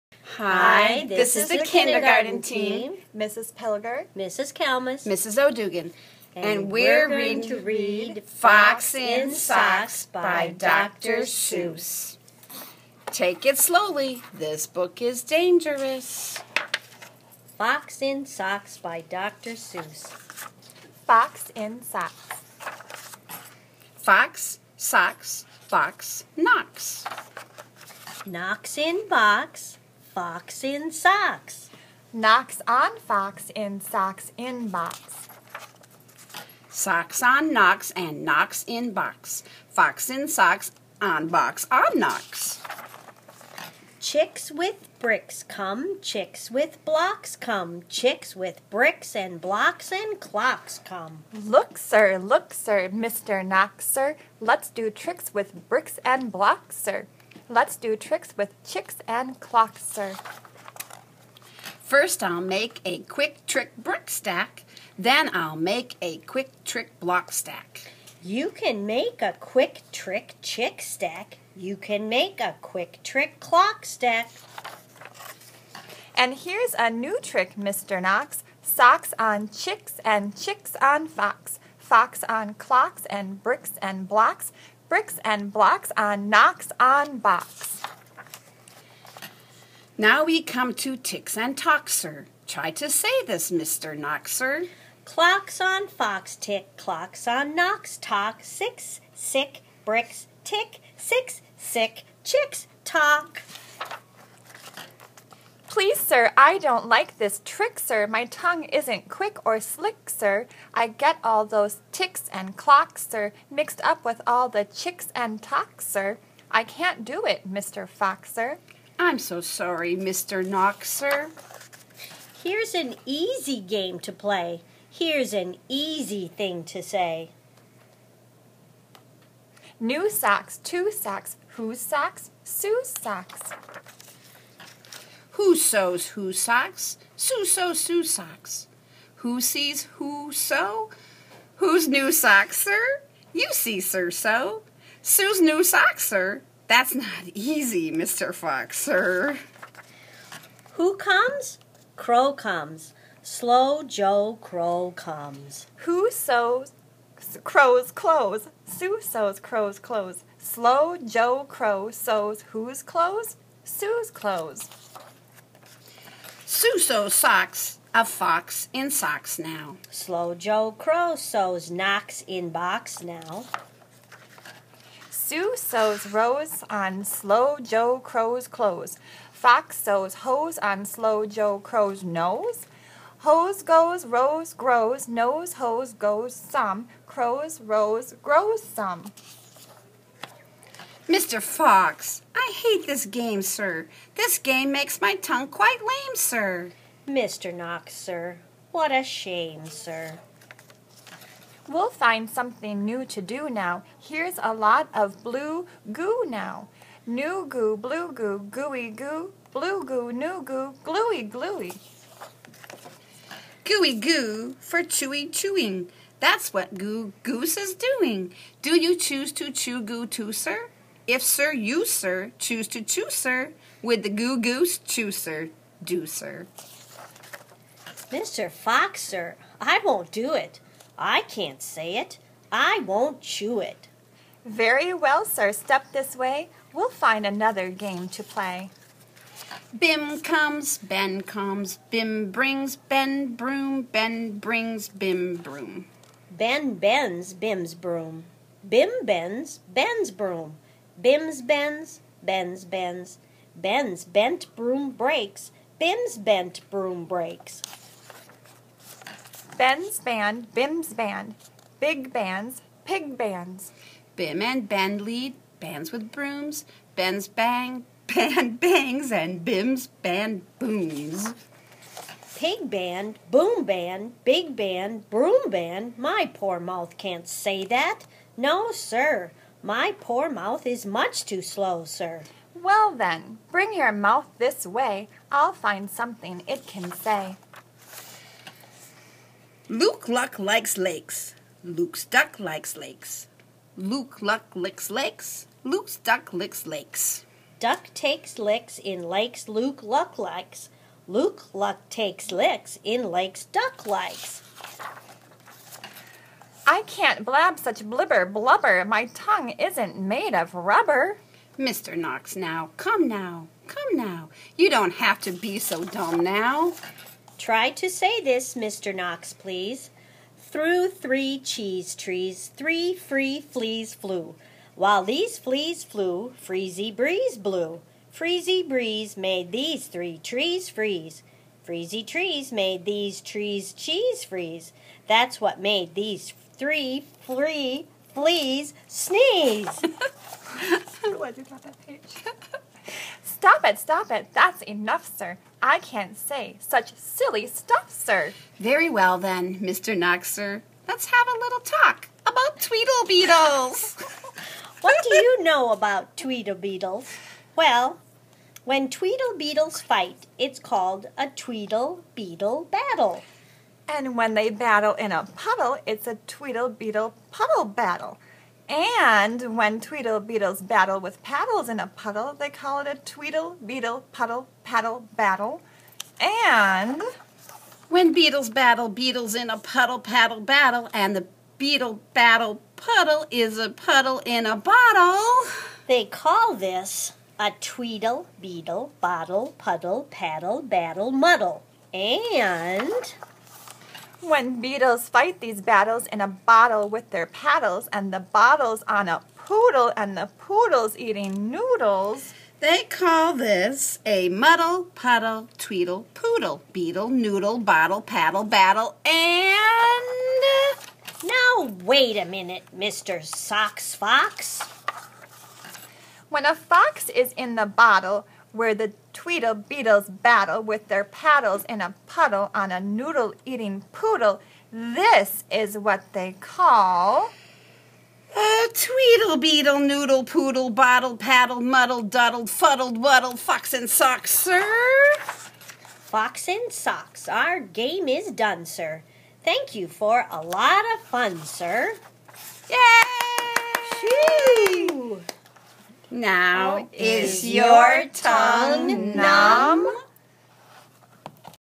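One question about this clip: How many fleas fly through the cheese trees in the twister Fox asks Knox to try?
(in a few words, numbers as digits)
3.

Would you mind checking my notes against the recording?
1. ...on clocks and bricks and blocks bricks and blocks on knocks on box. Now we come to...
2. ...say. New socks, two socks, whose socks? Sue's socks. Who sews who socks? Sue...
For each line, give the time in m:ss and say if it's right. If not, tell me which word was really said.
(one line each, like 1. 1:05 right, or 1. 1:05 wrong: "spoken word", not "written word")
1. 1:22 right
2. 2:06 right.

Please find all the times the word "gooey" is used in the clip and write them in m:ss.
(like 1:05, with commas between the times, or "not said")
3:28, 3:33.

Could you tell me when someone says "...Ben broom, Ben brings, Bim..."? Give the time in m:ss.
4:02.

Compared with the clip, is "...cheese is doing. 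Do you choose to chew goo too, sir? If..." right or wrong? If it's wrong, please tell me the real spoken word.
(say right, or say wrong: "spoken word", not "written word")
wrong: "goose", not "cheese".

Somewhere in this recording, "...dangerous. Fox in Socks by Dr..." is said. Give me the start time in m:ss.
0:15.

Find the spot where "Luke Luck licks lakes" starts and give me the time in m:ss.
4:53.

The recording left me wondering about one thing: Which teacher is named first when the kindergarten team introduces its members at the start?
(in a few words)
Mrs. Pilger.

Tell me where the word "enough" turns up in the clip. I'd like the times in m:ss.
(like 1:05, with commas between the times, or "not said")
5:44.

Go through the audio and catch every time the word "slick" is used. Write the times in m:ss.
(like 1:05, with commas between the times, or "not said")
1:49.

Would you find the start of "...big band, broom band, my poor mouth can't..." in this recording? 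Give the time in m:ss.
4:34.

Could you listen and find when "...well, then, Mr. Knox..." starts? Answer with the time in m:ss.
5:48.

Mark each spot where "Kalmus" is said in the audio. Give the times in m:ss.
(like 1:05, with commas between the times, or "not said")
0:04.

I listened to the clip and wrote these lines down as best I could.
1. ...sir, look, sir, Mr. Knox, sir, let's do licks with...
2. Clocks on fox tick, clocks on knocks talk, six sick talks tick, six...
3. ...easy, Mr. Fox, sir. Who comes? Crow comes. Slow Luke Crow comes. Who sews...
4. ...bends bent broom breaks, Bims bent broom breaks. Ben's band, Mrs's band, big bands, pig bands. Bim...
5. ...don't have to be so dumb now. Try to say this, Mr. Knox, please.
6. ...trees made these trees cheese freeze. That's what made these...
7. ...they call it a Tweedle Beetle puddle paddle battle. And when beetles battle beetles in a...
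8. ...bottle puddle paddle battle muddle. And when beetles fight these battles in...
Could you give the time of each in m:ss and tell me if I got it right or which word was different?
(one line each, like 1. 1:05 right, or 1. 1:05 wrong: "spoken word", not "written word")
1. 0:51 wrong: "tricks", not "licks"
2. 1:35 wrong: "bricks", not "talks"
3. 2:27 wrong: "Joe", not "Luke"
4. 4:13 wrong: "Bim", not "Mrs"
5. 5:14 right
6. 5:32 right
7. 6:12 right
8. 6:29 right.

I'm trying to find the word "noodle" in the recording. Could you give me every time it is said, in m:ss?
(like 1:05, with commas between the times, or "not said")
6:41, 6:47, 7:02, 7:09.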